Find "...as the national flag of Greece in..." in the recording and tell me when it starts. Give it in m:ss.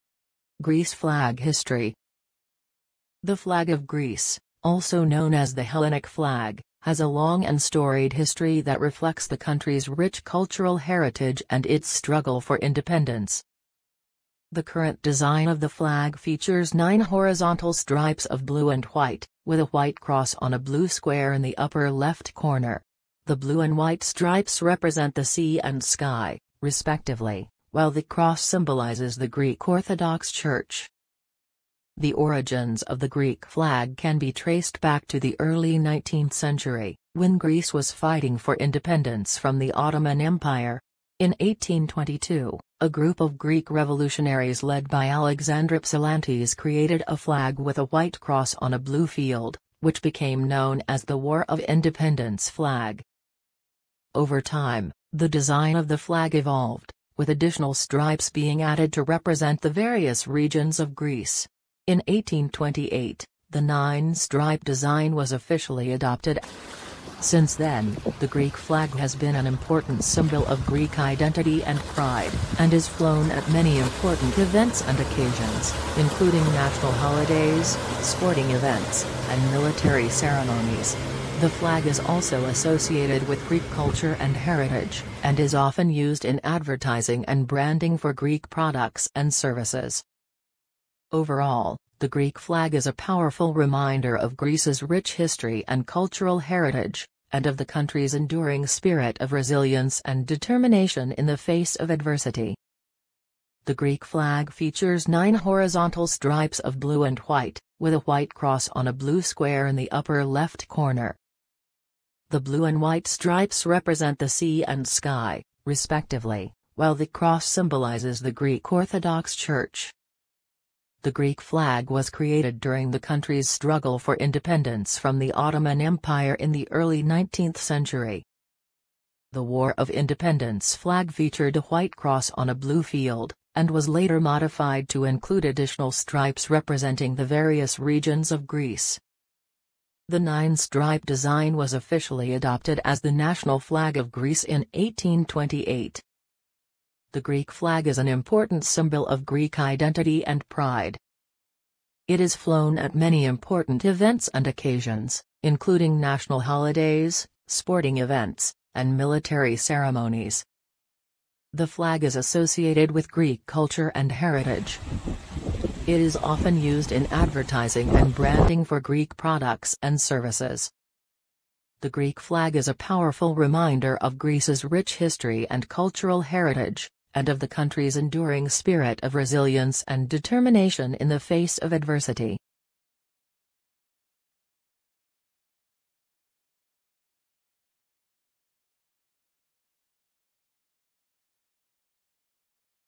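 2:22.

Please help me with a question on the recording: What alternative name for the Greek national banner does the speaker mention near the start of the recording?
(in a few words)
Hellenic flag.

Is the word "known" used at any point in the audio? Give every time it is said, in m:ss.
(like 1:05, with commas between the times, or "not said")
0:05, 0:50.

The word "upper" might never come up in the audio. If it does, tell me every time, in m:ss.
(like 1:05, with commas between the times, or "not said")
0:21, 1:49.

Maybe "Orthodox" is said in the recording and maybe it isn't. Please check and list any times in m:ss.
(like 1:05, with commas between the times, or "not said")
0:29, 1:58.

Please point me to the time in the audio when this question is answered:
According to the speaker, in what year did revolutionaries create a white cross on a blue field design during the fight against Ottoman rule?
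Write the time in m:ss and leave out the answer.
0:41.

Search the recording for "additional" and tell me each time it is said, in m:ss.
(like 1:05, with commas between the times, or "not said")
0:57, 2:15.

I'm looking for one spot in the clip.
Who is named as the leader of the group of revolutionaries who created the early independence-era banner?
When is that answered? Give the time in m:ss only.
0:45.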